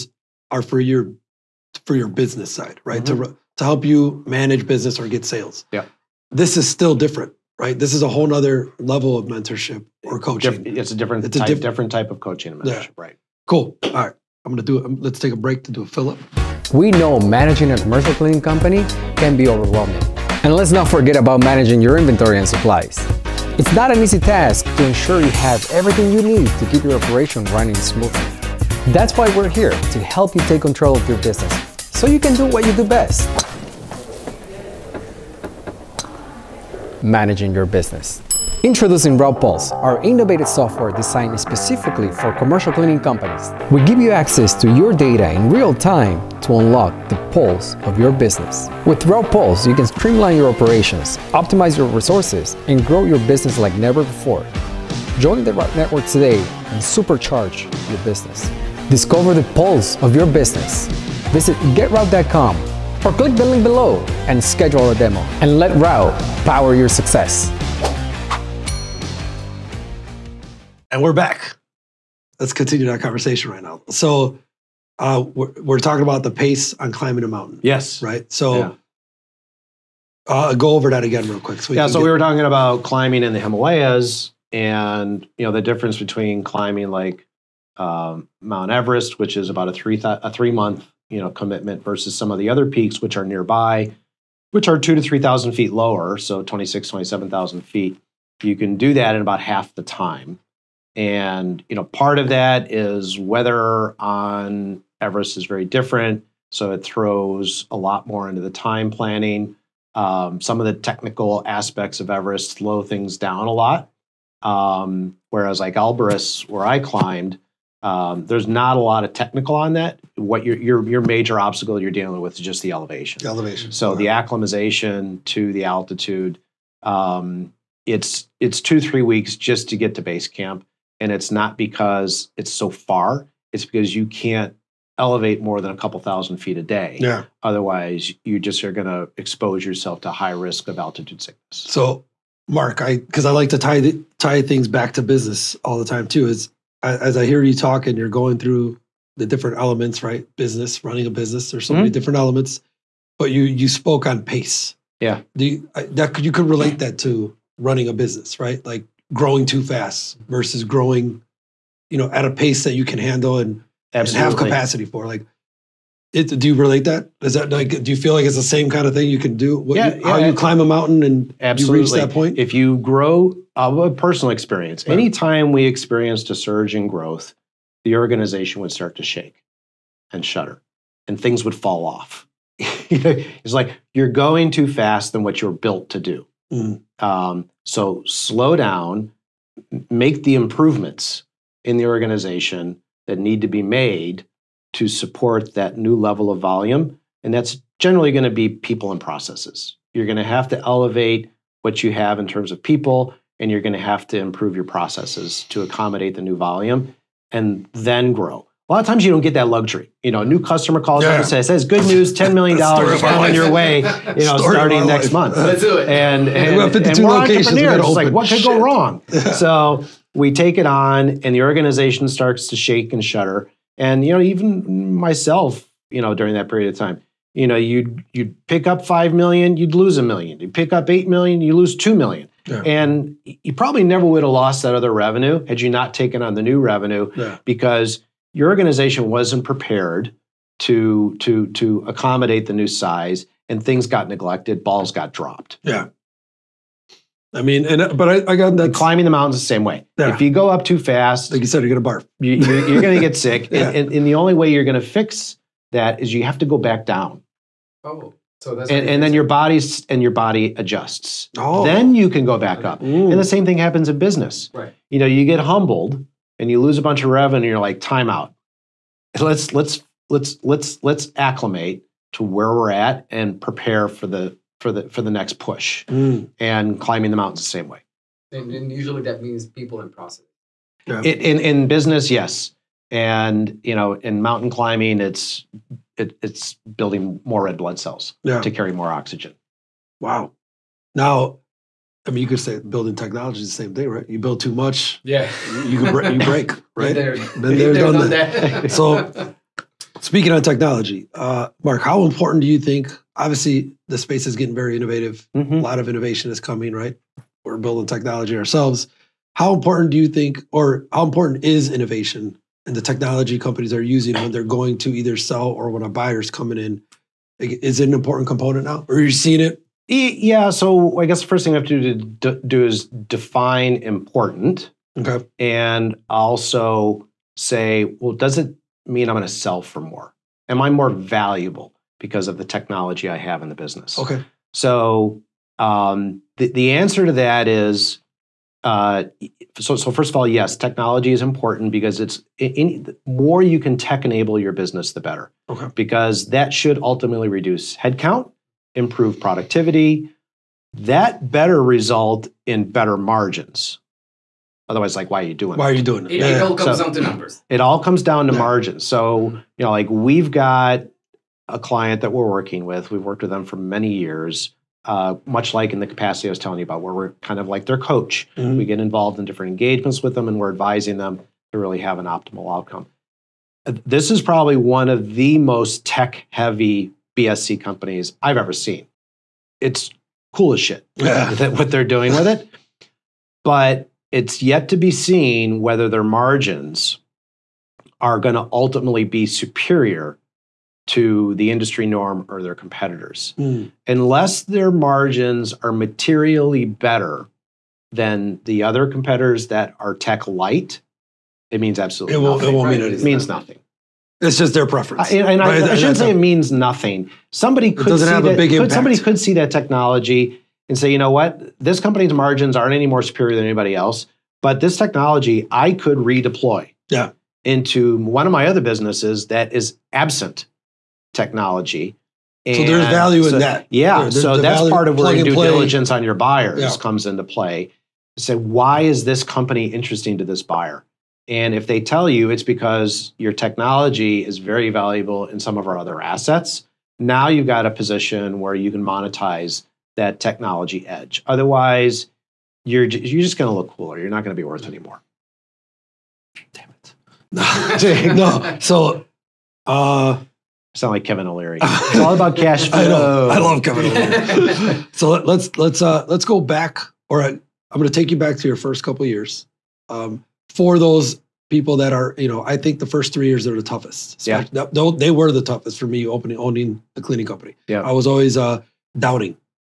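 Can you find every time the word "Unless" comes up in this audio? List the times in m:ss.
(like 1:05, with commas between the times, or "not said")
6:33.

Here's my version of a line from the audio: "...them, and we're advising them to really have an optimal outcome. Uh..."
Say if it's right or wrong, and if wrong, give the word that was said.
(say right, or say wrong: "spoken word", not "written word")
right.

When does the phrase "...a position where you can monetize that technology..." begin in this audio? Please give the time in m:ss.
7:17.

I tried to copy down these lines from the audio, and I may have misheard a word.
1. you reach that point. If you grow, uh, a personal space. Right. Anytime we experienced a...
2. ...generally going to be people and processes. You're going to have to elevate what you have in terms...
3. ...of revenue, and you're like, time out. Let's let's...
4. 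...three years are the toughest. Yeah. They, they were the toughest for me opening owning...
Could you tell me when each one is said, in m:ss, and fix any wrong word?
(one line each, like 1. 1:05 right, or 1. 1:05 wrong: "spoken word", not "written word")
1. 2:51 wrong: "experience", not "space"
2. 3:17 right
3. 4:27 right
4. 7:43 right.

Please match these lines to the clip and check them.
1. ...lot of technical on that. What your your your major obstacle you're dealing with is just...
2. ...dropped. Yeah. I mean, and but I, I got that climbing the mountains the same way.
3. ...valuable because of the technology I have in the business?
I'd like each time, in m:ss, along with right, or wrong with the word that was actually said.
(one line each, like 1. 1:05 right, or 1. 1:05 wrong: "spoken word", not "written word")
1. 1:58 right
2. 4:05 right
3. 5:30 right.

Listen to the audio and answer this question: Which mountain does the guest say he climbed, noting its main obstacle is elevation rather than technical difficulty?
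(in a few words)
Elbrus.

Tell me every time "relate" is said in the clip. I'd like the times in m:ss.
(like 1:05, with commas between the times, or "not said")
2:36, 2:46.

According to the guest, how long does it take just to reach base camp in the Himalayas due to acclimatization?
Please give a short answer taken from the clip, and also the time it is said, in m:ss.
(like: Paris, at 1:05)
2-3 weeks, at 2:08.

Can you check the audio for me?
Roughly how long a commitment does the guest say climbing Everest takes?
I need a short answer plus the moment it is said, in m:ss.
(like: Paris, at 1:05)
3 months, at 1:30.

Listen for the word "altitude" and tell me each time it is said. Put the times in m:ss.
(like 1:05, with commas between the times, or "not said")
2:05, 2:20.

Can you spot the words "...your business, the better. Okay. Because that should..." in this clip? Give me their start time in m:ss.
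5:44.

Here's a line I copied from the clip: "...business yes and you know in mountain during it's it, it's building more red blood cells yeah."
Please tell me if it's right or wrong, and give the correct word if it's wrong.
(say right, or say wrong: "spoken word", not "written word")
wrong: "climbing", not "during".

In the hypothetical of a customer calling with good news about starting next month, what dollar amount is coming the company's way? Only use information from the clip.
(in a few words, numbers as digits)
$10 million.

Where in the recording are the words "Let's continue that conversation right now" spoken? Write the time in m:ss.
1:12.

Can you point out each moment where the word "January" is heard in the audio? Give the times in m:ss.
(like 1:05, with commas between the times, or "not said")
not said.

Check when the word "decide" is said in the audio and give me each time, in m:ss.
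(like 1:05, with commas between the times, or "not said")
not said.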